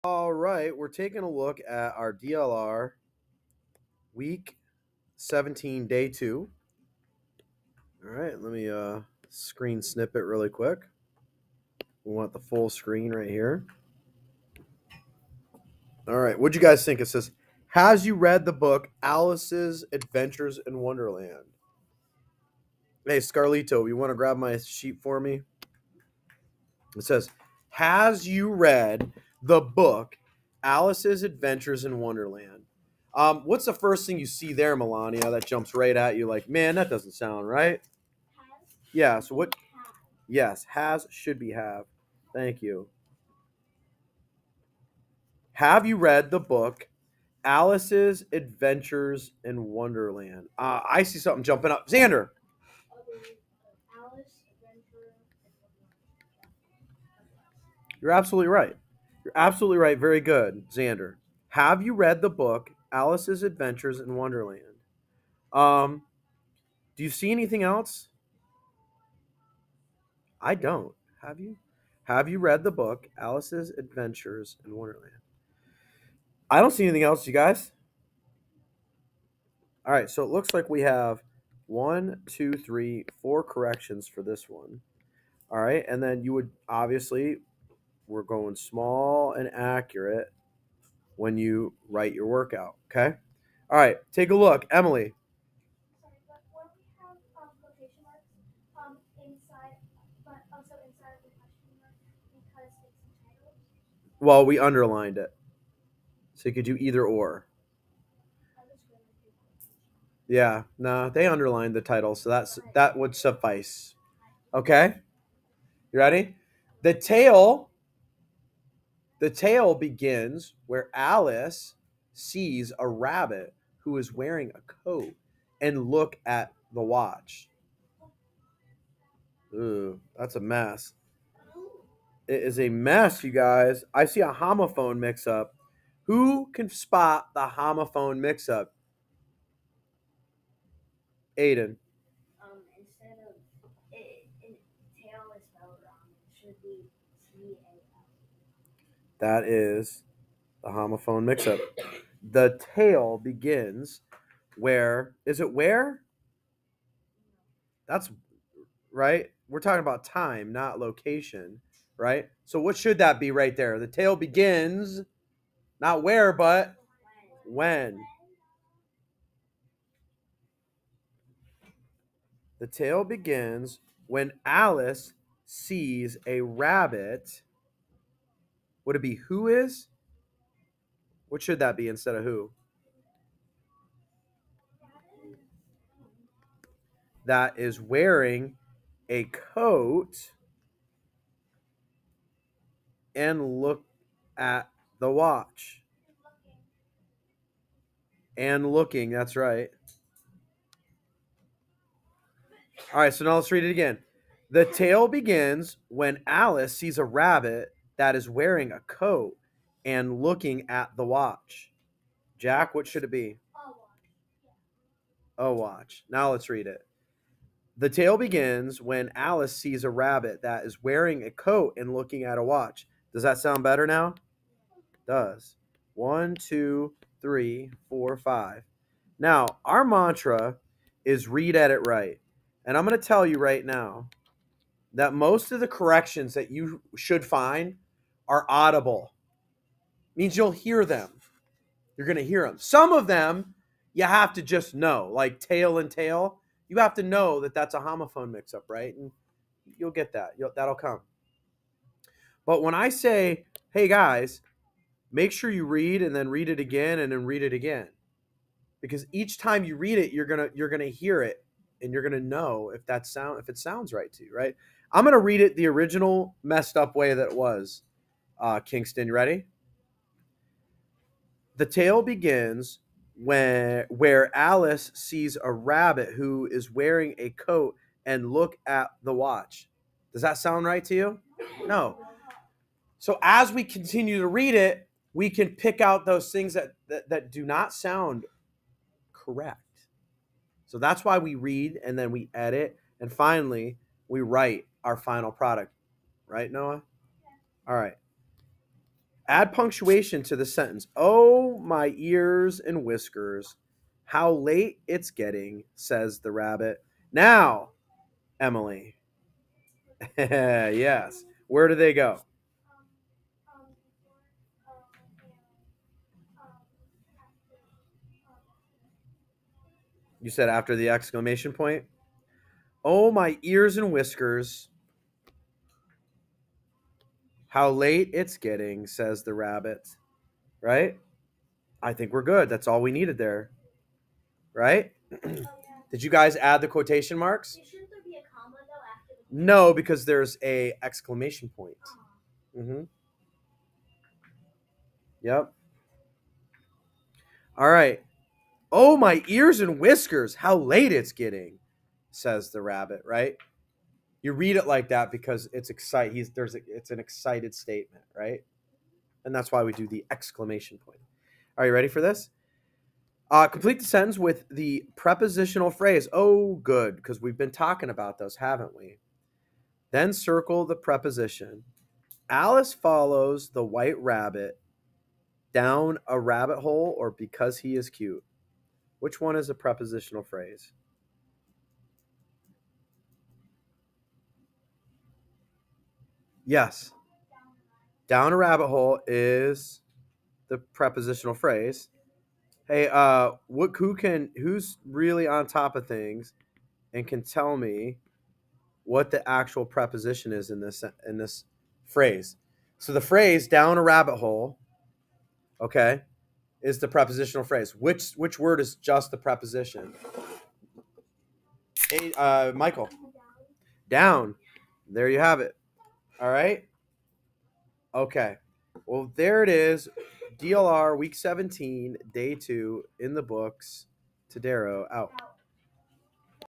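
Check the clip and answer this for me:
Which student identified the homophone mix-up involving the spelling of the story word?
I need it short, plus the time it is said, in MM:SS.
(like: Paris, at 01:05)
Aiden, at 02:21.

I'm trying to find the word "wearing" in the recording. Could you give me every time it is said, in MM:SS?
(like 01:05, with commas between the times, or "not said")
02:04, 03:07, 03:28, 03:40, 04:36.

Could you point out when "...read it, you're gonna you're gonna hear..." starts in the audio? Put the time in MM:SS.
04:19.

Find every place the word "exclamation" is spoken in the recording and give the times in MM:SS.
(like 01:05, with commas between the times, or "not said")
05:20, 05:40, 06:00.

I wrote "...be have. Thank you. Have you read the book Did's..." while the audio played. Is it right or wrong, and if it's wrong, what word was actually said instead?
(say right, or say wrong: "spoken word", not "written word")
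wrong: "Alice", not "Did".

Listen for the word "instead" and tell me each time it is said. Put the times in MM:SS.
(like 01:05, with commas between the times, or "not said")
02:22, 03:01.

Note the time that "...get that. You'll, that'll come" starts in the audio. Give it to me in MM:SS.
04:09.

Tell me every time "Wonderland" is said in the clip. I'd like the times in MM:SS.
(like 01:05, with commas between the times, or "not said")
00:20, 00:31, 00:49, 01:04, 01:14.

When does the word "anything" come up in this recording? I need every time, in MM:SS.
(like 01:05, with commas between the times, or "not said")
01:07, 01:16.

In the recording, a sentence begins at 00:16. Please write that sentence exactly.
All right, what'd you guys think?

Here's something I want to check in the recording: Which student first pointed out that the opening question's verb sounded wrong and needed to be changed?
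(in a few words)
Melania.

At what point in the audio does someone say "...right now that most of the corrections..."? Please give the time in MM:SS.
03:53.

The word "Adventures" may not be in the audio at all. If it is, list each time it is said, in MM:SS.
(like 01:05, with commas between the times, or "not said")
00:19, 00:31, 00:48, 01:03, 01:13.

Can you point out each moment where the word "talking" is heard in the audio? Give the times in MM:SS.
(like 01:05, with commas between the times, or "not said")
02:39, 06:07.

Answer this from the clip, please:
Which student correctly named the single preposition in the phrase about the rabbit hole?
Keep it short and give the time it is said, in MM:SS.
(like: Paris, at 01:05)
Michael, at 06:52.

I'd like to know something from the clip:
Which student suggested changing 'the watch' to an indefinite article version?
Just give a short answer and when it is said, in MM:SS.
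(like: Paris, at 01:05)
Jack, at 03:32.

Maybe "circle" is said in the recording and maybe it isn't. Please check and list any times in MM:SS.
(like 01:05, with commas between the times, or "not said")
06:10.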